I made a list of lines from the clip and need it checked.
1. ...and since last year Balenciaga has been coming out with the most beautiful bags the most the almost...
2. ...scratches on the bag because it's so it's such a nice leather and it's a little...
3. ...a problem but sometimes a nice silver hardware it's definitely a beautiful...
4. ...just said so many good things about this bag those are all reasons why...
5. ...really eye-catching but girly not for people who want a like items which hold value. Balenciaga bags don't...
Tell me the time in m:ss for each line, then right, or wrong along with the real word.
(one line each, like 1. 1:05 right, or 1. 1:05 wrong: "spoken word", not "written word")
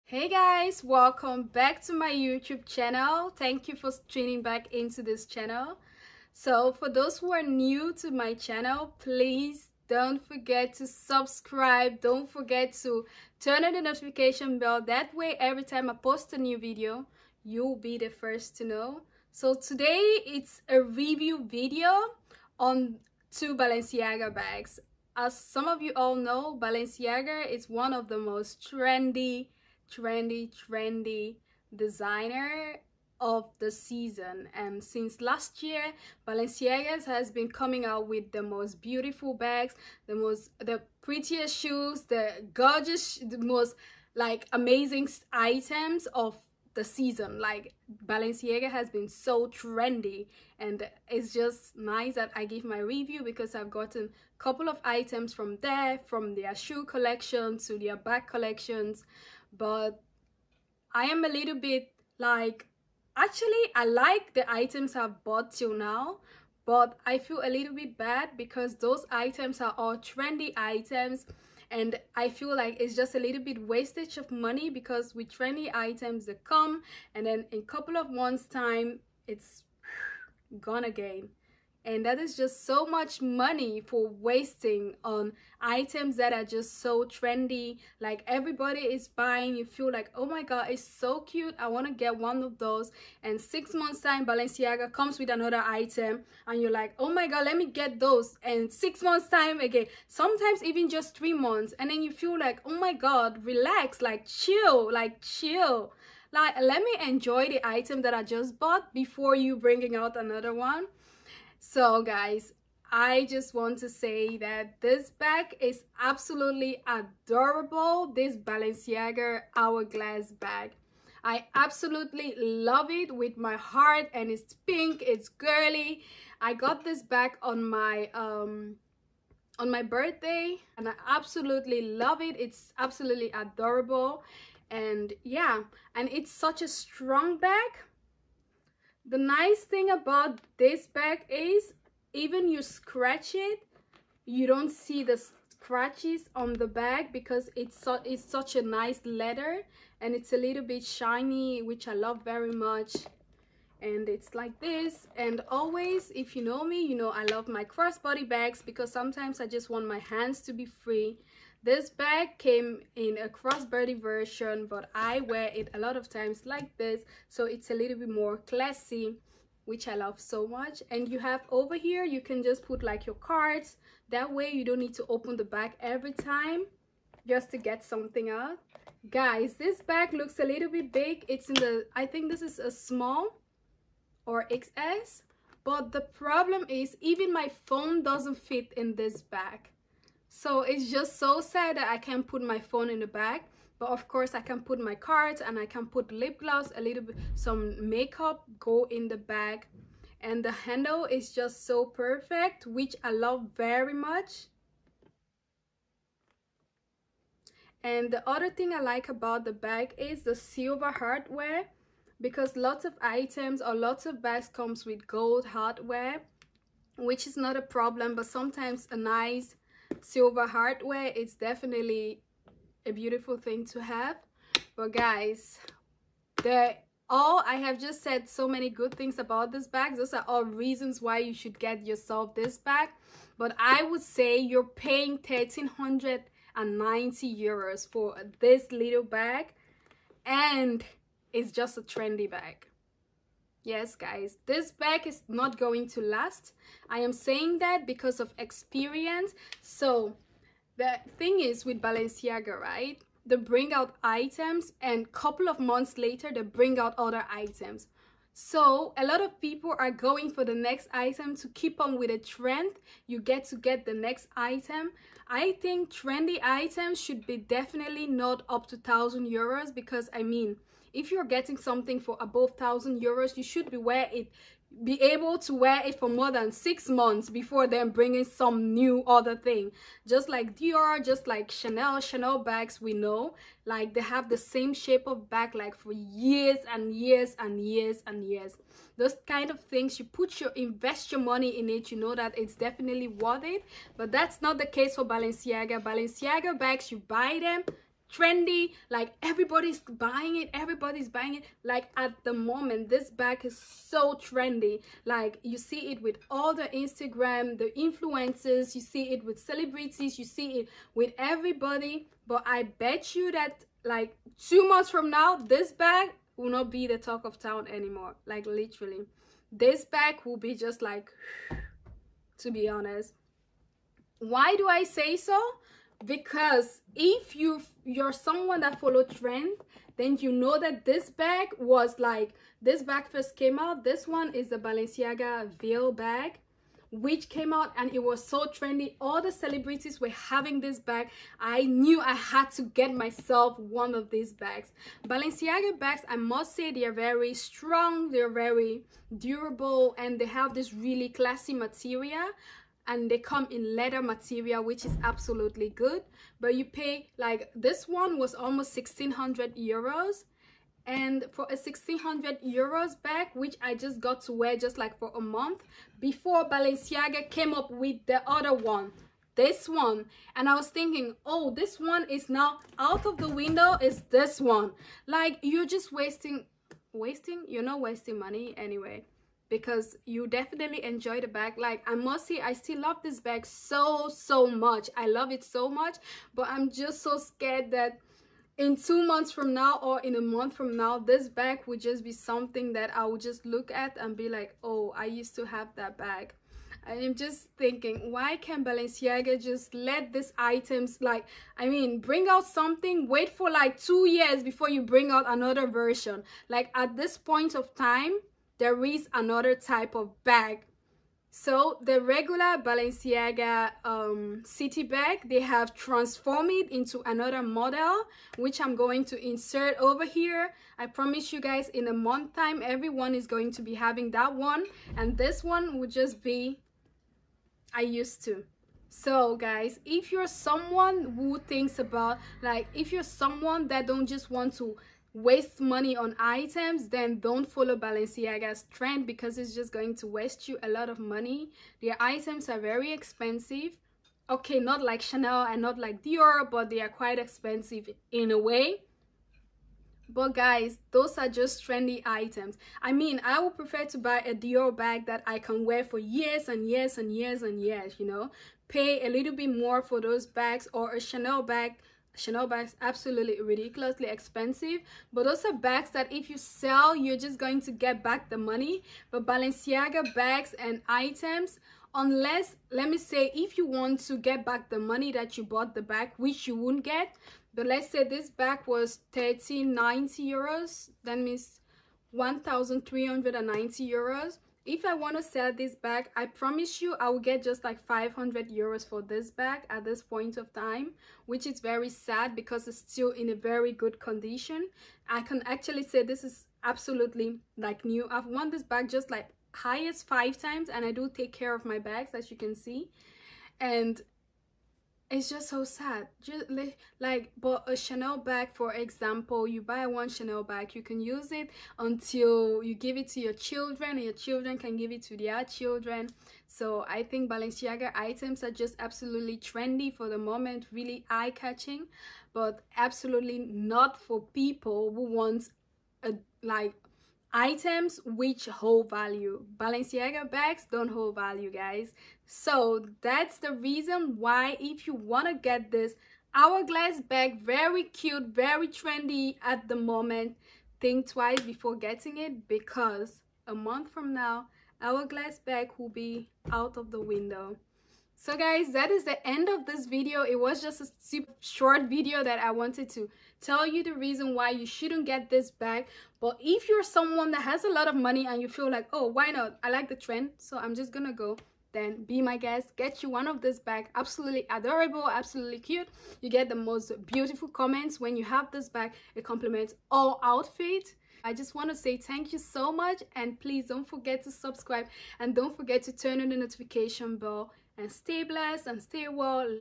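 1. 0:34 wrong: "prettiest", not "almost"
2. 2:25 right
3. 3:37 right
4. 3:47 right
5. 8:40 wrong: "absolutely", not "girly".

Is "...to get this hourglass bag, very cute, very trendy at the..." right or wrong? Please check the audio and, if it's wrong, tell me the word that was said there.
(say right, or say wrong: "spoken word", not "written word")
right.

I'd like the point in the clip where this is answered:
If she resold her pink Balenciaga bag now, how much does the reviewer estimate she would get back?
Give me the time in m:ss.
8:07.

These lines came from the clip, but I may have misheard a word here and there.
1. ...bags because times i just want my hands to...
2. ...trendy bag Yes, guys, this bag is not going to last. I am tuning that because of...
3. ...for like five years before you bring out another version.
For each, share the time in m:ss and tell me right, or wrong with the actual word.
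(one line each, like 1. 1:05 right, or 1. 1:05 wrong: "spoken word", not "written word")
1. 2:38 wrong: "sometimes", not "times"
2. 4:01 wrong: "saying", not "tuning"
3. 6:43 wrong: "two", not "five".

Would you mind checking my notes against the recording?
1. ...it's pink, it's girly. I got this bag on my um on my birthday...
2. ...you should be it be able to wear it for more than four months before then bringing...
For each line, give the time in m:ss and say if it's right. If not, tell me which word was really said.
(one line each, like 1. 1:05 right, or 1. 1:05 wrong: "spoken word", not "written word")
1. 2:04 right
2. 4:33 wrong: "six", not "four".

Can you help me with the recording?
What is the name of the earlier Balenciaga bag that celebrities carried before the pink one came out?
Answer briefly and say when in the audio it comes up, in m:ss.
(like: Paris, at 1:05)
Ville bag, at 5:35.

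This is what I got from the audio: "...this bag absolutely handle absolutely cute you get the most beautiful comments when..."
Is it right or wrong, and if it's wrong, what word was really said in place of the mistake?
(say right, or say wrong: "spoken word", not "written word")
wrong: "adorable", not "handle".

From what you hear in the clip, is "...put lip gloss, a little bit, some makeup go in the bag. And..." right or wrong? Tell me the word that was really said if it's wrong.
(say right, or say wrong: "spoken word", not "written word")
right.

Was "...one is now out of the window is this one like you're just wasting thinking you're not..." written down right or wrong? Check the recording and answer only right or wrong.
wrong.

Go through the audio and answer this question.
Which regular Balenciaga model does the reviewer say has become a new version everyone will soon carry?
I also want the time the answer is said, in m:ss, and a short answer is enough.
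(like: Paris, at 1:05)
city bag, at 6:54.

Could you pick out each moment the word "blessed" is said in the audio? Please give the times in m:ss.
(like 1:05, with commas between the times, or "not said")
9:38.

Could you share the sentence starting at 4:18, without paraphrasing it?
So a lot of people are going for the next item to keep on with the trend.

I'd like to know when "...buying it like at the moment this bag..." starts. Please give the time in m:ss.
5:01.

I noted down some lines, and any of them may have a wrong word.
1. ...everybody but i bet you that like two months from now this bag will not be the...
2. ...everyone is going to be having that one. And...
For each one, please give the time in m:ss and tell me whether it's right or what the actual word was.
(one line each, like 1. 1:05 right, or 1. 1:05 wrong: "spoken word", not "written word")
1. 5:11 right
2. 7:02 right.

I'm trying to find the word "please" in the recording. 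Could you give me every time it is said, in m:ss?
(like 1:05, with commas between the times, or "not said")
0:08, 9:33.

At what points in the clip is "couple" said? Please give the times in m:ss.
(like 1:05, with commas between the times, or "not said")
0:54, 1:17, 4:15.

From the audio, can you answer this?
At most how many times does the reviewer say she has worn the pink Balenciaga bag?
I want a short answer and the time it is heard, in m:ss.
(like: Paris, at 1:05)
5, at 8:20.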